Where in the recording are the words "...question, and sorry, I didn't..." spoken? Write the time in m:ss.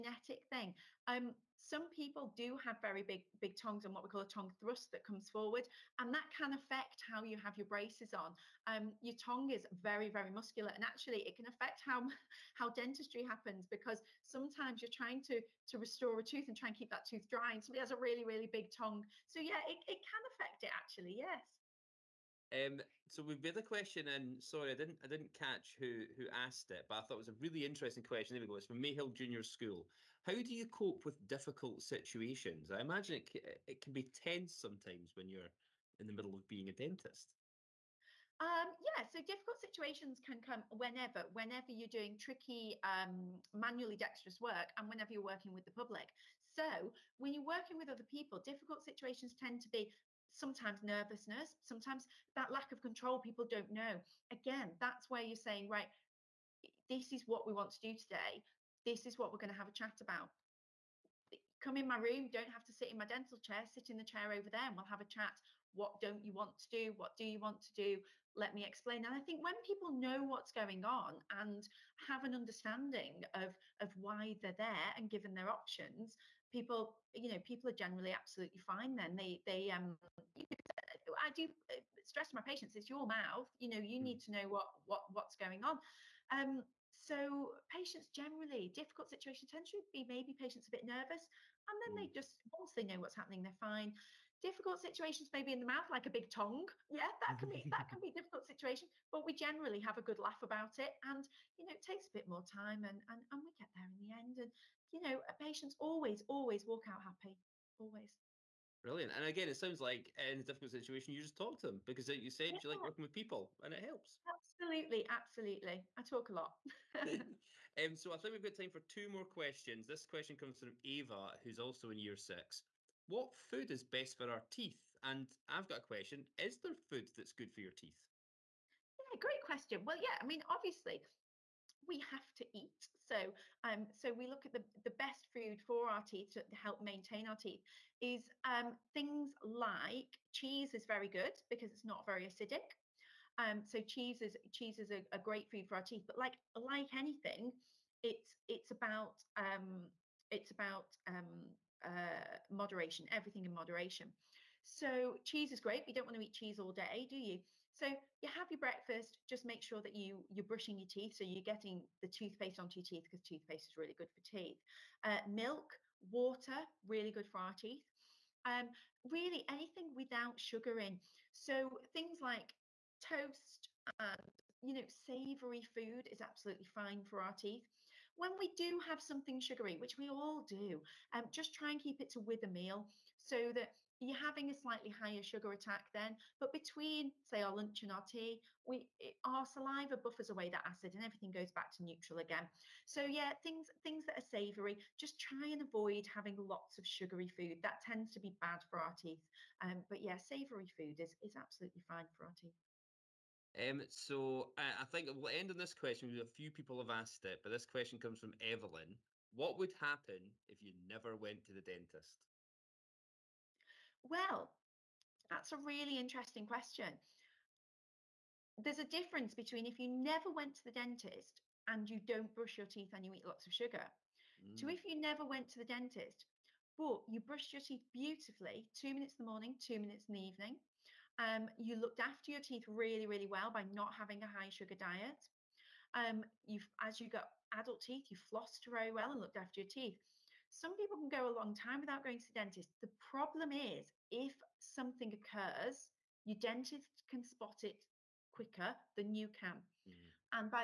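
0:23.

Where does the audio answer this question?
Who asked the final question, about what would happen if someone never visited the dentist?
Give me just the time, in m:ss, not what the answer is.
3:28.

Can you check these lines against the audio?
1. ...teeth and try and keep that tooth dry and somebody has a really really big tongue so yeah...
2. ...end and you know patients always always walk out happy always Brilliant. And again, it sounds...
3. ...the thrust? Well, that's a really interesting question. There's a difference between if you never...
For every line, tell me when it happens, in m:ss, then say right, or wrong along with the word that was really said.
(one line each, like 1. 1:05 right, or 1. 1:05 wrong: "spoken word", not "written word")
1. 0:16 wrong: "tooth", not "teeth"
2. 1:44 right
3. 3:31 wrong: "dentist", not "thrust".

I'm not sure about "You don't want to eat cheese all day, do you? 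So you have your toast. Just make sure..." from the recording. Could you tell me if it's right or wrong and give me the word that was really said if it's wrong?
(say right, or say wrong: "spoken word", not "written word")
wrong: "breakfast", not "toast".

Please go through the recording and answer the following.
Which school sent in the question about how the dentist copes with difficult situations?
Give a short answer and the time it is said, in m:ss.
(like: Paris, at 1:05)
Mayhill Junior School, at 0:28.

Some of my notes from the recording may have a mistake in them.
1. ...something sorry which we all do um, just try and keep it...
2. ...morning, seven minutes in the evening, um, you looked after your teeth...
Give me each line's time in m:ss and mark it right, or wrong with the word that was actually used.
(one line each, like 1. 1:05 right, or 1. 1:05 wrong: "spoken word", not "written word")
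1. 2:59 wrong: "sugary", not "sorry"
2. 3:49 wrong: "two", not "seven".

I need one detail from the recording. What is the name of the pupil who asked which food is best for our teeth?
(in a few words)
Ava.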